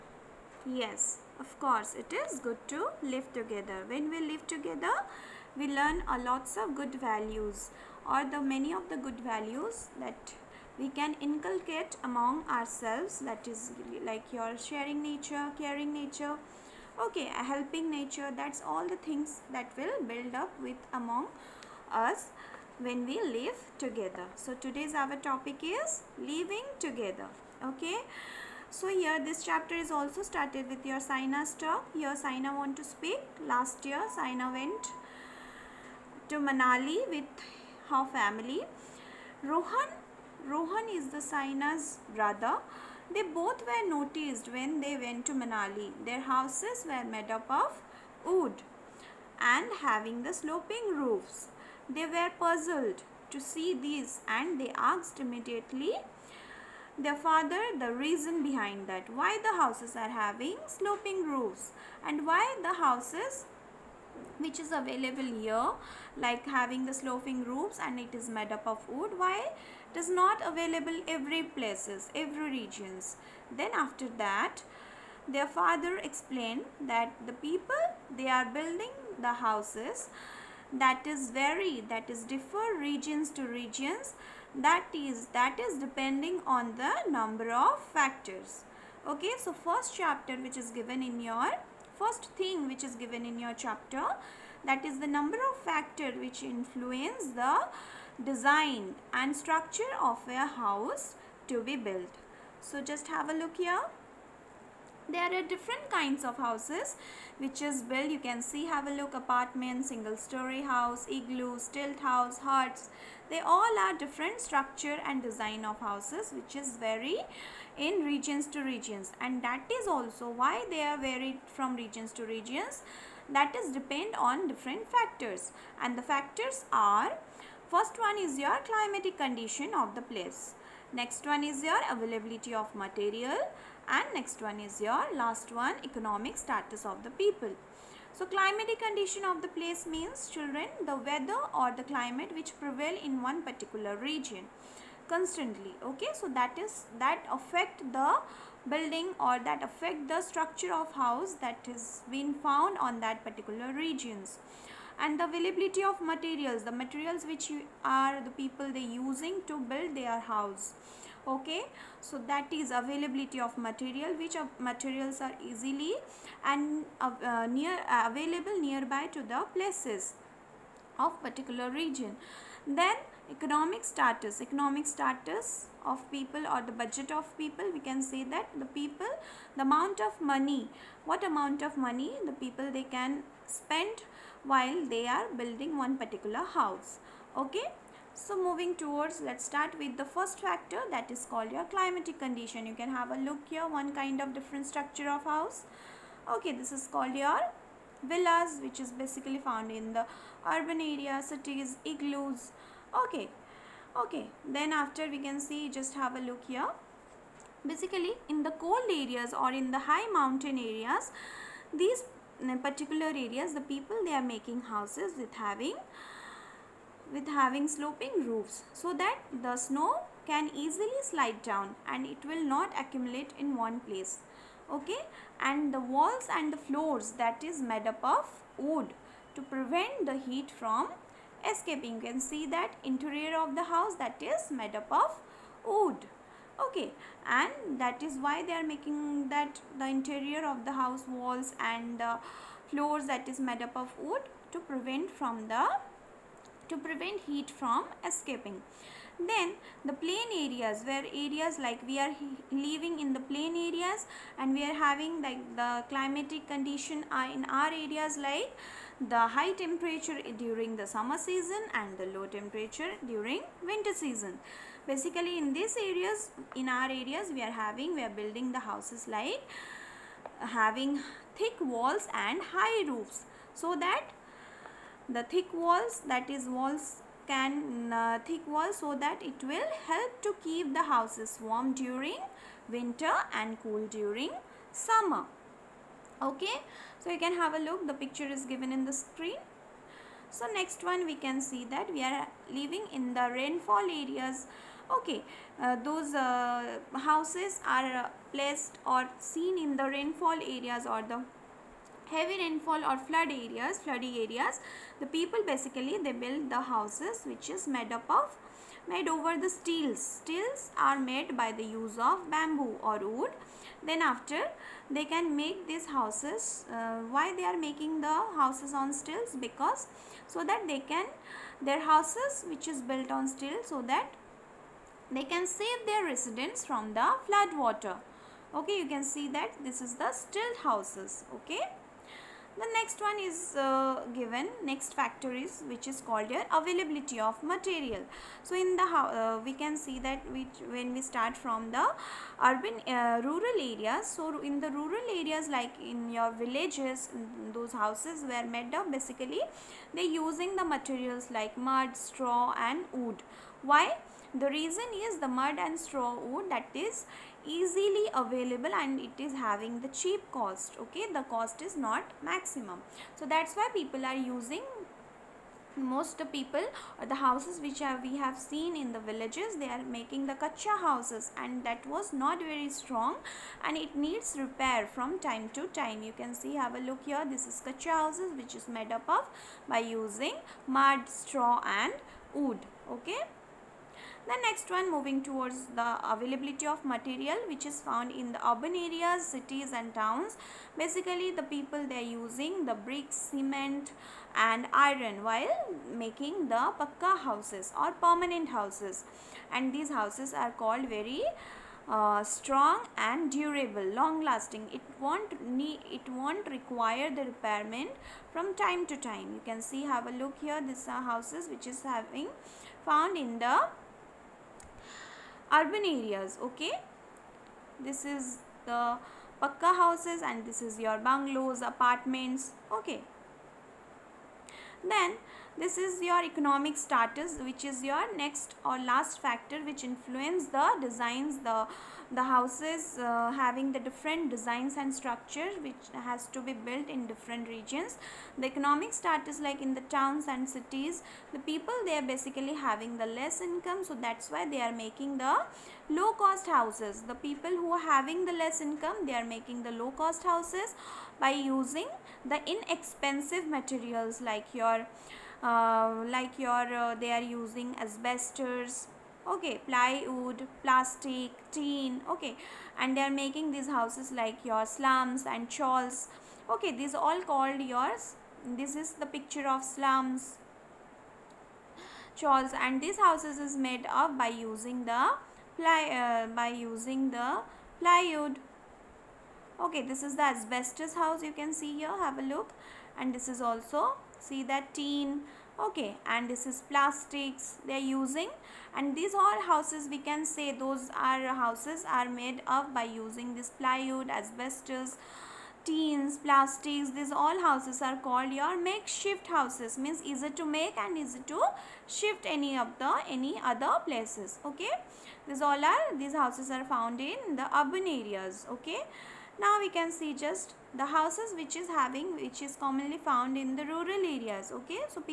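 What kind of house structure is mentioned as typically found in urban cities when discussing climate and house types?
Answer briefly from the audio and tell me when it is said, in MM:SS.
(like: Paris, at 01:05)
Villas, at 03:18.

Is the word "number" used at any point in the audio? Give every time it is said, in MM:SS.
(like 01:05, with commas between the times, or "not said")
01:27, 01:35.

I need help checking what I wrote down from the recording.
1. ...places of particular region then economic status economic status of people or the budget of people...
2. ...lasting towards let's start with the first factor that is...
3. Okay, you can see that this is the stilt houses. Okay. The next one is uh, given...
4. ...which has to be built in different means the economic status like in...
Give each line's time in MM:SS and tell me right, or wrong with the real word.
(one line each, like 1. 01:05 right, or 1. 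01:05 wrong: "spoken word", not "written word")
1. 02:49 right
2. 03:08 wrong: "moving", not "lasting"
3. 05:28 right
4. 07:15 wrong: "regions", not "means".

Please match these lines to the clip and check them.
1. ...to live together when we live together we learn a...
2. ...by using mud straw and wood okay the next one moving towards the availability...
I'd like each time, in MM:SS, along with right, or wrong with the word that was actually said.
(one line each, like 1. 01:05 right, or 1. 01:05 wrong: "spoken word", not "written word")
1. 00:02 right
2. 06:19 right.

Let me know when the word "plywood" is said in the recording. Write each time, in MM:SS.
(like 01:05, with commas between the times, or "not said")
07:39, 07:57, 08:13.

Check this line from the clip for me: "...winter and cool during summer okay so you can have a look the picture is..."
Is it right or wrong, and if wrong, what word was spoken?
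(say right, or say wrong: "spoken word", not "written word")
right.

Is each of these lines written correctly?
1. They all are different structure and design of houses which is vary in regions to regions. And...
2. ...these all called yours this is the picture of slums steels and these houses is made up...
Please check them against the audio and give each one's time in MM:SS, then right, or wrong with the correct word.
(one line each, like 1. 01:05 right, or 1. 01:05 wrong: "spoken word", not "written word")
1. 01:53 right
2. 07:46 wrong: "chawls", not "steels".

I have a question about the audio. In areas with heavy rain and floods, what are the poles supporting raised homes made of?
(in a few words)
Bamboo or wood.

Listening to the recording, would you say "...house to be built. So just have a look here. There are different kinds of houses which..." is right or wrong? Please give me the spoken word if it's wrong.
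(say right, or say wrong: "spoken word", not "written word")
right.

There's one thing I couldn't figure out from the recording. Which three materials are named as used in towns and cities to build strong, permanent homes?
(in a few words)
Bricks, cement and iron.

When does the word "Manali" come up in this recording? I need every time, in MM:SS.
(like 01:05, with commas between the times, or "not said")
00:36, 00:45.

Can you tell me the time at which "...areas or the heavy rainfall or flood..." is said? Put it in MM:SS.
05:00.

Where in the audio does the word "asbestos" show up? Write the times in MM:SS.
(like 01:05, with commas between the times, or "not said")
07:37, 08:00, 08:14.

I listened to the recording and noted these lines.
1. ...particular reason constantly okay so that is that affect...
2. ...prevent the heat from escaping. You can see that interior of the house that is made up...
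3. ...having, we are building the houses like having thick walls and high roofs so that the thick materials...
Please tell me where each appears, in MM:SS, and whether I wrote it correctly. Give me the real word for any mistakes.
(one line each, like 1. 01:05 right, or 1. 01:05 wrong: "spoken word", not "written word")
1. 02:23 wrong: "region", not "reason"
2. 03:49 right
3. 04:27 wrong: "walls", not "materials".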